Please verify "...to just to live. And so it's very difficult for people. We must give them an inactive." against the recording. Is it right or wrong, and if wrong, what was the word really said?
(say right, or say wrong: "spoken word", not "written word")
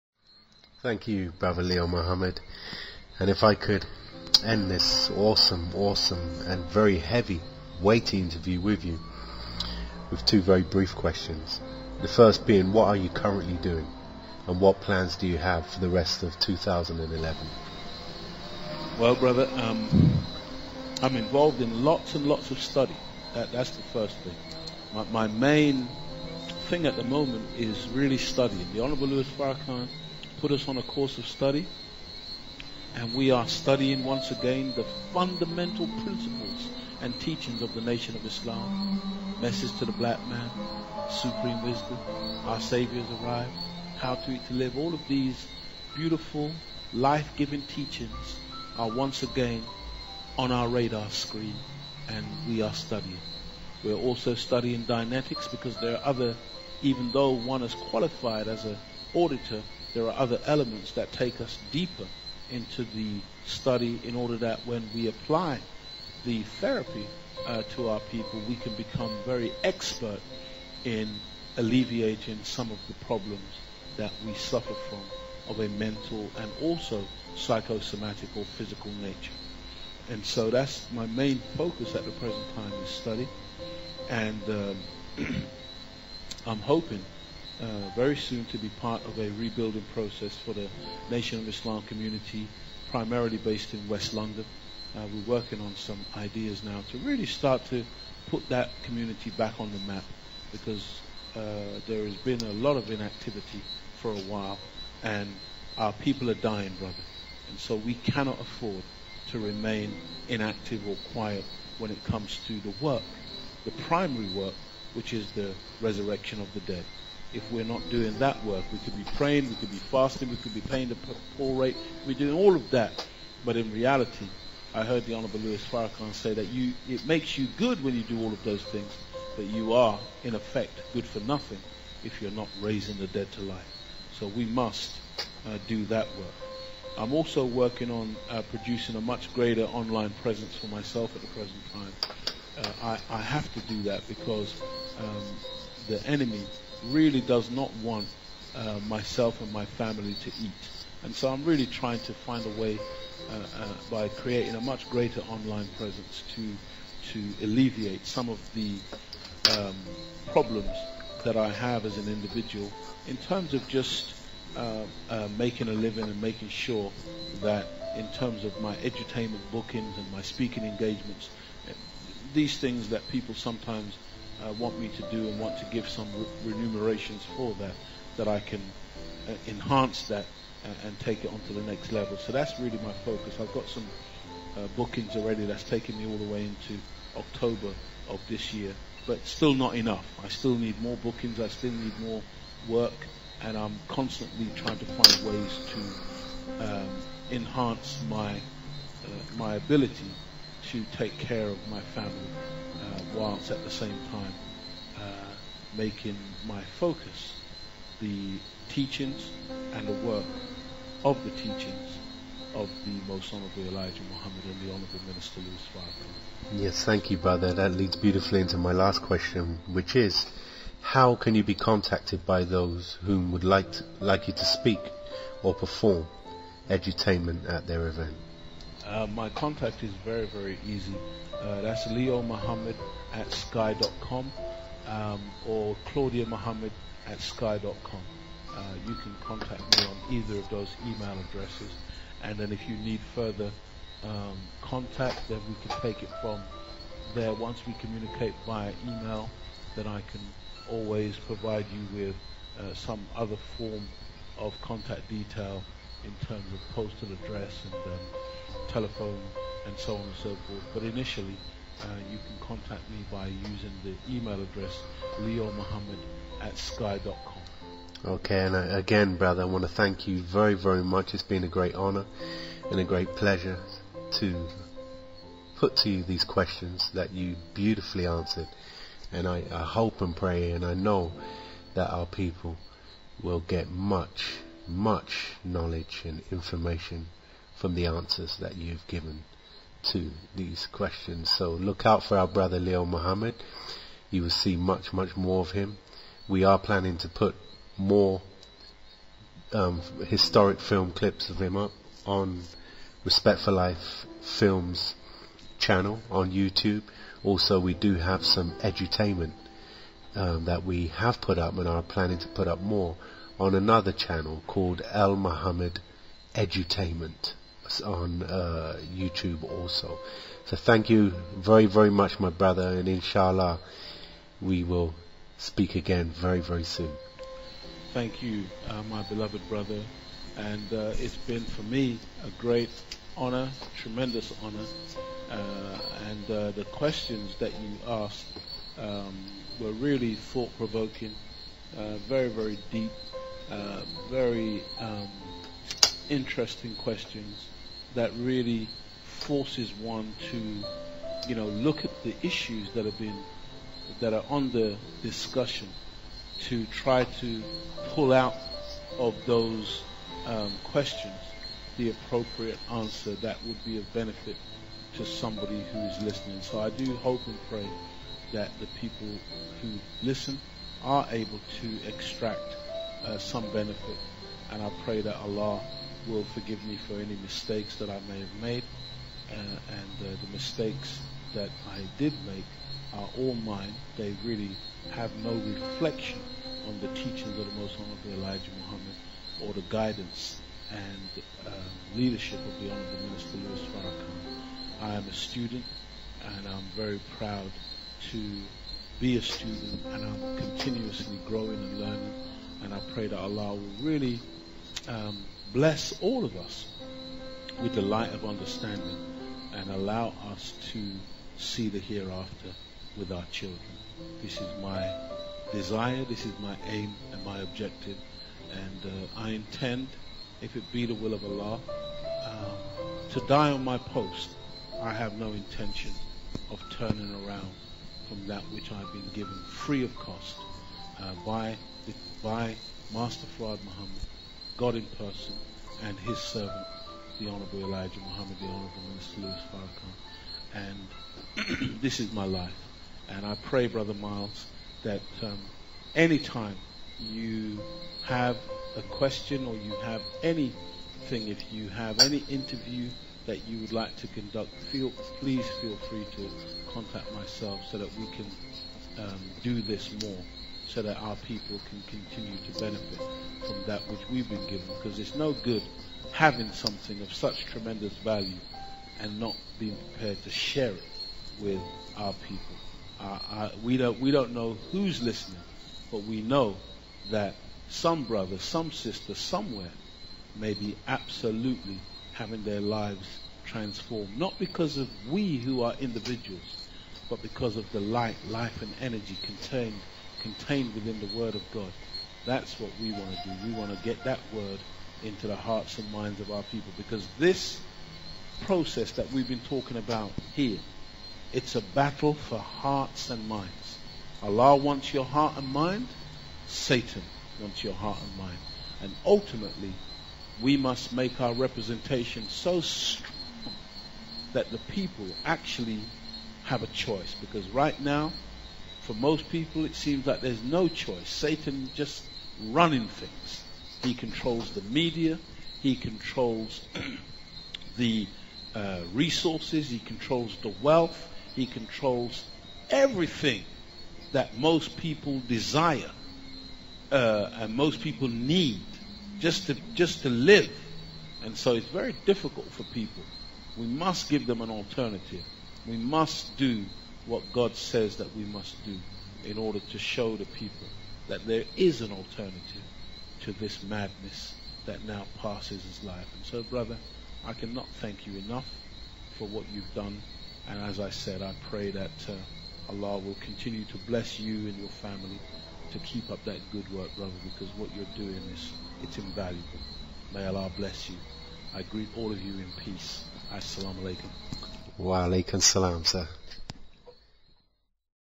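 wrong: "alternative", not "inactive".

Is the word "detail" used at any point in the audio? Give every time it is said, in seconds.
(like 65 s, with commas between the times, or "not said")
255 s.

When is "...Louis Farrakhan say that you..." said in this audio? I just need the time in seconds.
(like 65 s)
125 s.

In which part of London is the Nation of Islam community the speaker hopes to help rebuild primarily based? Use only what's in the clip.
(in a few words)
West London.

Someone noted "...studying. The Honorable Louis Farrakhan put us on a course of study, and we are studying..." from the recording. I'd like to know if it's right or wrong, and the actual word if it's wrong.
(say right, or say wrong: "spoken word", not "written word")
right.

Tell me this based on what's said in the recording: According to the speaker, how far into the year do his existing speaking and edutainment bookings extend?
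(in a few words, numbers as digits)
October.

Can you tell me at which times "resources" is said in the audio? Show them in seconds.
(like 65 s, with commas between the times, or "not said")
528 s.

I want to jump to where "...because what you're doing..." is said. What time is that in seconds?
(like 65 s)
567 s.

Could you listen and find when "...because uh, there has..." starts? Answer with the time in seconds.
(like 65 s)
100 s.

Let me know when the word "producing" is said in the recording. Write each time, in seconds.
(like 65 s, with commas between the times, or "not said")
138 s.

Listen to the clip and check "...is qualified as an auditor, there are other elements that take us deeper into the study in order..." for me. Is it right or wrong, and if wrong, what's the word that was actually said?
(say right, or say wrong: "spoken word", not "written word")
right.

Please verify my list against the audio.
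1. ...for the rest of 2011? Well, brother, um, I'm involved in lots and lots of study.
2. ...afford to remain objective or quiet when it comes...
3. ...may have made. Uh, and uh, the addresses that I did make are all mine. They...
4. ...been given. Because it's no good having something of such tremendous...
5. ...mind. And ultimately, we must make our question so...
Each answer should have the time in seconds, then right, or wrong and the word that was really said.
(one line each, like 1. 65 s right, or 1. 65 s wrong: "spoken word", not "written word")
1. 15 s right
2. 108 s wrong: "inactive", not "objective"
3. 378 s wrong: "mistakes", not "addresses"
4. 464 s right
5. 508 s wrong: "representation", not "question".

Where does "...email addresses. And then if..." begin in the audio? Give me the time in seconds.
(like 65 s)
240 s.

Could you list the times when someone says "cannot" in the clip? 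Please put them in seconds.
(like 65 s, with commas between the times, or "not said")
107 s, 557 s.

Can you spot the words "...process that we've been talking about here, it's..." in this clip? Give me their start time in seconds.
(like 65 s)
498 s.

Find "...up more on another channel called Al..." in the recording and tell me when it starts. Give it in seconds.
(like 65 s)
312 s.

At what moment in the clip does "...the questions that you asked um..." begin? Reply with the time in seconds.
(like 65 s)
336 s.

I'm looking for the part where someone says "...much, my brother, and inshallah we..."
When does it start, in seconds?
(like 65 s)
321 s.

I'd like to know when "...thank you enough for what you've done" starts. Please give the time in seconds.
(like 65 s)
557 s.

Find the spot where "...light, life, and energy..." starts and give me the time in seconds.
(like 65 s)
487 s.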